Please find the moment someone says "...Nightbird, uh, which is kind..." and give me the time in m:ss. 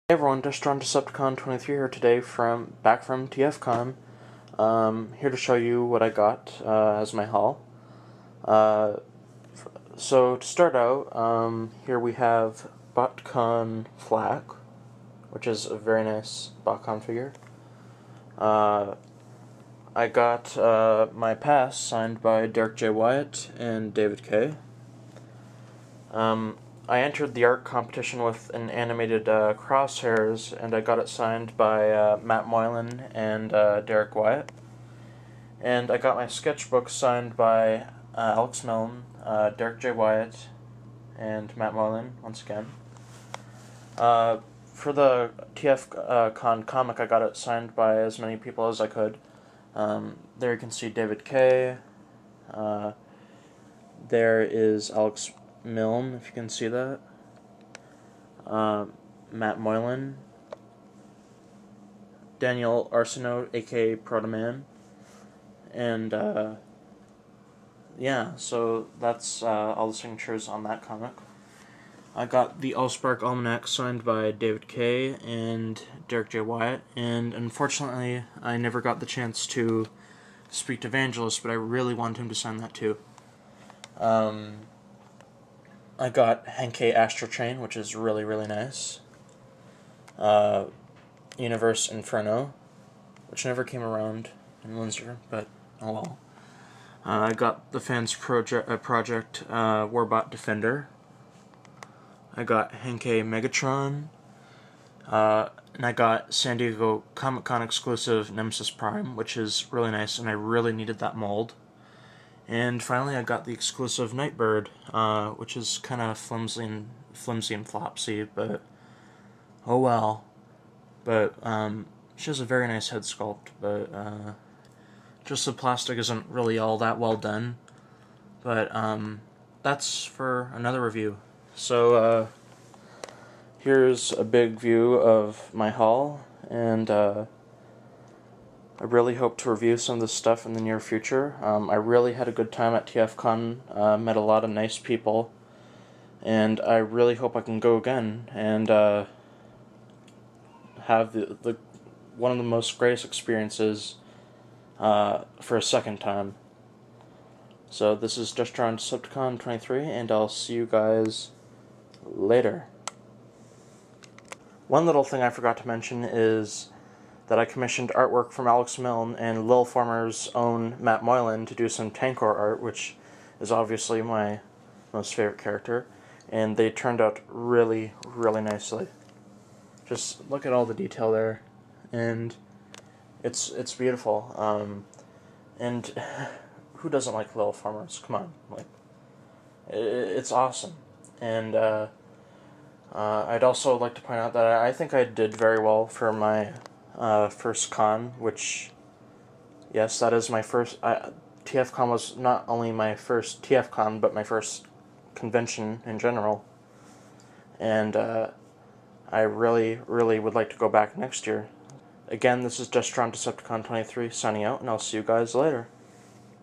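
1:54.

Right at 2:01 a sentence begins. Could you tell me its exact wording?
But um, she has a very nice head sculpt, but uh, just the plastic isn't really all that well done.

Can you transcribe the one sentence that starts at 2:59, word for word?
Just look at all the detail there, and it's it's beautiful.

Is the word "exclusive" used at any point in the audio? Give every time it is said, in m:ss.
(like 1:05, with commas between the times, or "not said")
1:47, 1:53.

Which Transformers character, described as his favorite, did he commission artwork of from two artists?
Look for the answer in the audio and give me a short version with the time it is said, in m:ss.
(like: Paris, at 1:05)
Tankor, at 2:51.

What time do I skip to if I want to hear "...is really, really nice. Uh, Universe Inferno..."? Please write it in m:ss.
1:27.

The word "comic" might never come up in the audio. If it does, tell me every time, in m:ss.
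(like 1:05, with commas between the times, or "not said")
0:46, 1:10, 1:47.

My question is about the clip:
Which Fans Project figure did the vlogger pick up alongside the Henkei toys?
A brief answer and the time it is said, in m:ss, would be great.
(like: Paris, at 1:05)
Warbot Defender, at 1:39.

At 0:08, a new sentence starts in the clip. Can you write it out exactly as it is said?
Uh, so to start out, um, here we have BotCon Flak, which is a very nice BotCon figure.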